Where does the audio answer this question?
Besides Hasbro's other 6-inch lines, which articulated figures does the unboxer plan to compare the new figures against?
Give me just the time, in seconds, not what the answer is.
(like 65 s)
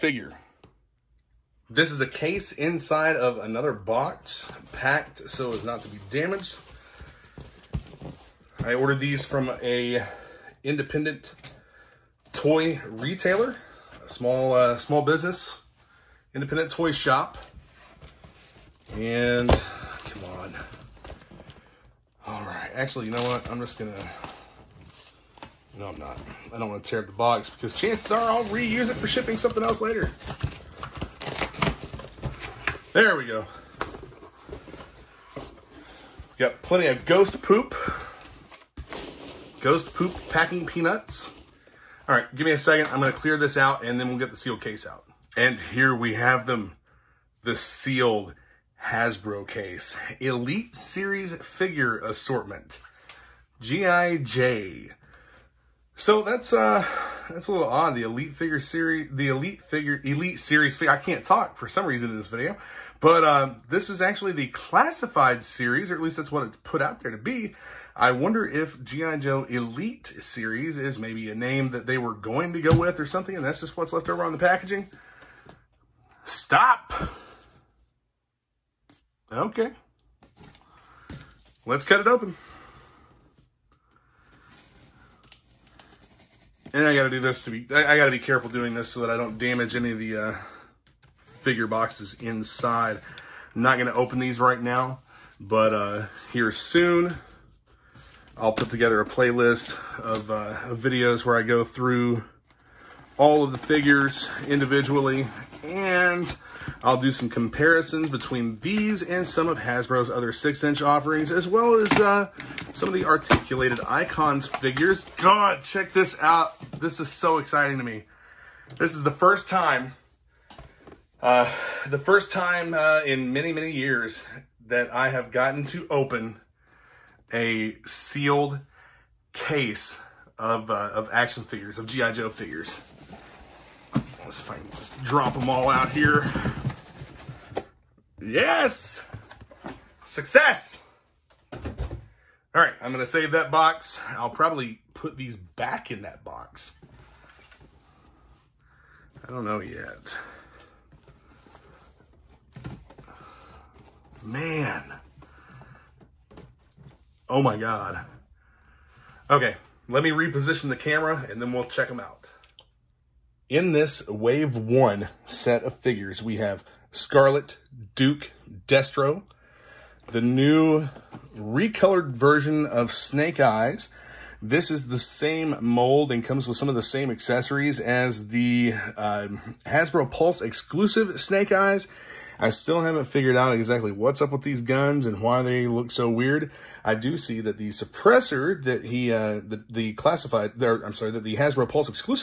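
113 s.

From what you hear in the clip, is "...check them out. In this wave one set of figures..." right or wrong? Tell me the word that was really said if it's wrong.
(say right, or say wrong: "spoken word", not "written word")
right.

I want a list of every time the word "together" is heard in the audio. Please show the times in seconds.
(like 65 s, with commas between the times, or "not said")
98 s.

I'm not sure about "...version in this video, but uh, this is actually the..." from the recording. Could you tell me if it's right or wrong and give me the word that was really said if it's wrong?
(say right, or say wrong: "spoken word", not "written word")
wrong: "reason", not "version".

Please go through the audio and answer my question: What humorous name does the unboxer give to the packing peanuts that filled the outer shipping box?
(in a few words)
Ghost Poop.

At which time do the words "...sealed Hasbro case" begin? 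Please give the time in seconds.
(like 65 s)
47 s.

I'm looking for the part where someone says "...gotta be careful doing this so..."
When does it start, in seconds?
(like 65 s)
87 s.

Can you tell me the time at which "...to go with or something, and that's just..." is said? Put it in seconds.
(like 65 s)
72 s.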